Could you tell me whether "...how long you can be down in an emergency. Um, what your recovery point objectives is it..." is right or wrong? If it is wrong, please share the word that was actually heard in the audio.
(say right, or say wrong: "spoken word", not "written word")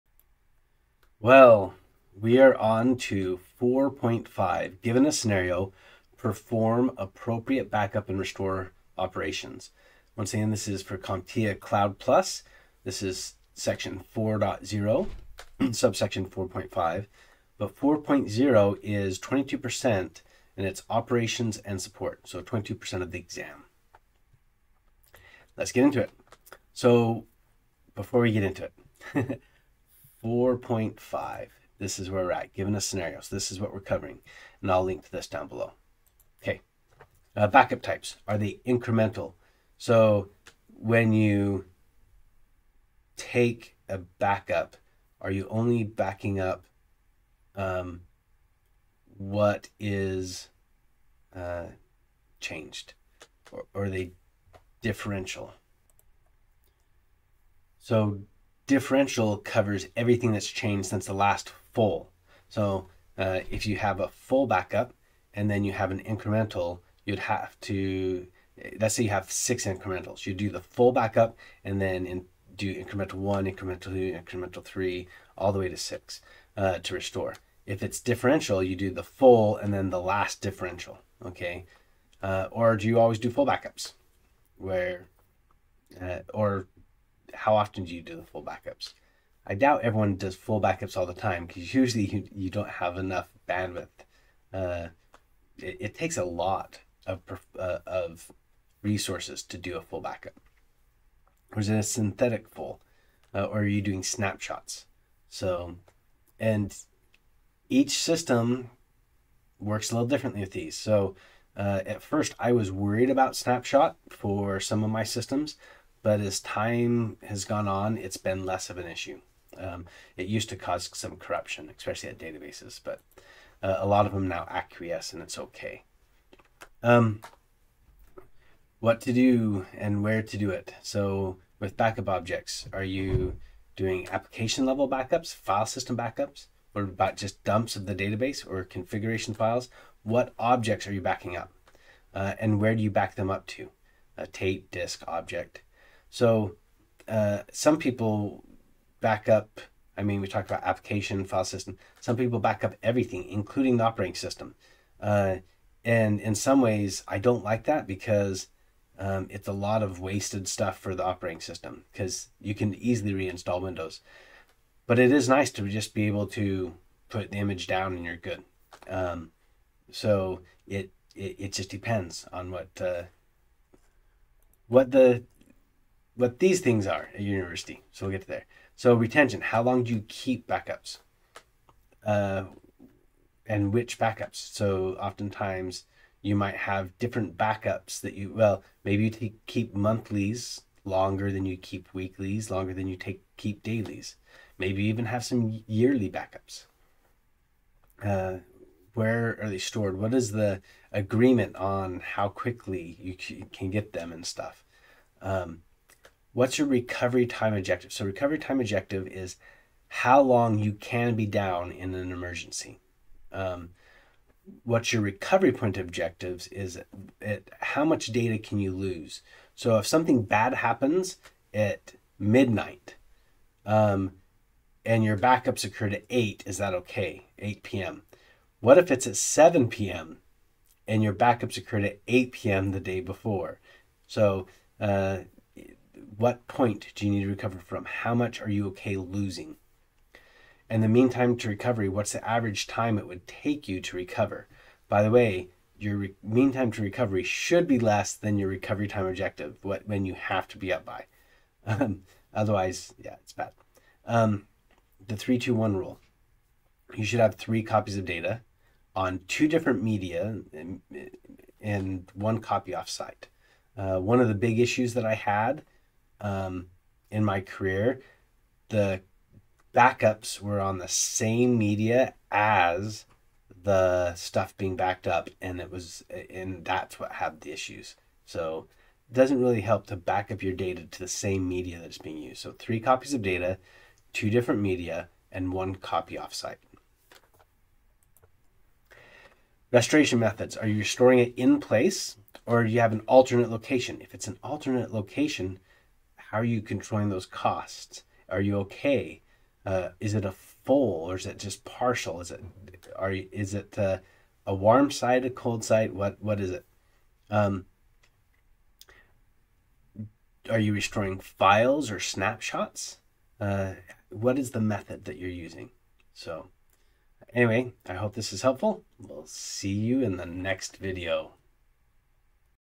right.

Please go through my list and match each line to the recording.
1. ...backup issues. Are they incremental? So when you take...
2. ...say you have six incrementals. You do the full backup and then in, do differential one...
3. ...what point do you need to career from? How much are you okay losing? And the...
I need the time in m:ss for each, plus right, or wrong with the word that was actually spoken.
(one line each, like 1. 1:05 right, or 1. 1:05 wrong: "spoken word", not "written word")
1. 0:37 wrong: "types", not "issues"
2. 1:08 wrong: "incremental", not "differential"
3. 3:56 wrong: "recover", not "career".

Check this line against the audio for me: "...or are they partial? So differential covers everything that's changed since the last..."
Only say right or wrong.
wrong.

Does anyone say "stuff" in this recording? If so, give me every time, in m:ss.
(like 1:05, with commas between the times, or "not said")
2:40, 3:24, 4:34.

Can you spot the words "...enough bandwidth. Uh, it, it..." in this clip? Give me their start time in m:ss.
1:32.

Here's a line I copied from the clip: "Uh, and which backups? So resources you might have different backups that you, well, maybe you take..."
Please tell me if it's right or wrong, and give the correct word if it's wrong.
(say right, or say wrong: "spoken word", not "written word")
wrong: "oftentimes", not "resources".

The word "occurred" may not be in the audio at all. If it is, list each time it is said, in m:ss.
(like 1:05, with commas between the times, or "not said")
3:45, 3:51.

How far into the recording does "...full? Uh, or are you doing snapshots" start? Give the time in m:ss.
1:42.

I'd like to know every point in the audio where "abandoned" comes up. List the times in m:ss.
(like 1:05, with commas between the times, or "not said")
not said.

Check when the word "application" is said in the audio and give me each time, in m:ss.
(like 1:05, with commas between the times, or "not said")
2:14, 2:30.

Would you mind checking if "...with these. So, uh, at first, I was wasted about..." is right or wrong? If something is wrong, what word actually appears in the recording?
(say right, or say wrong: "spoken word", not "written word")
wrong: "worried", not "wasted".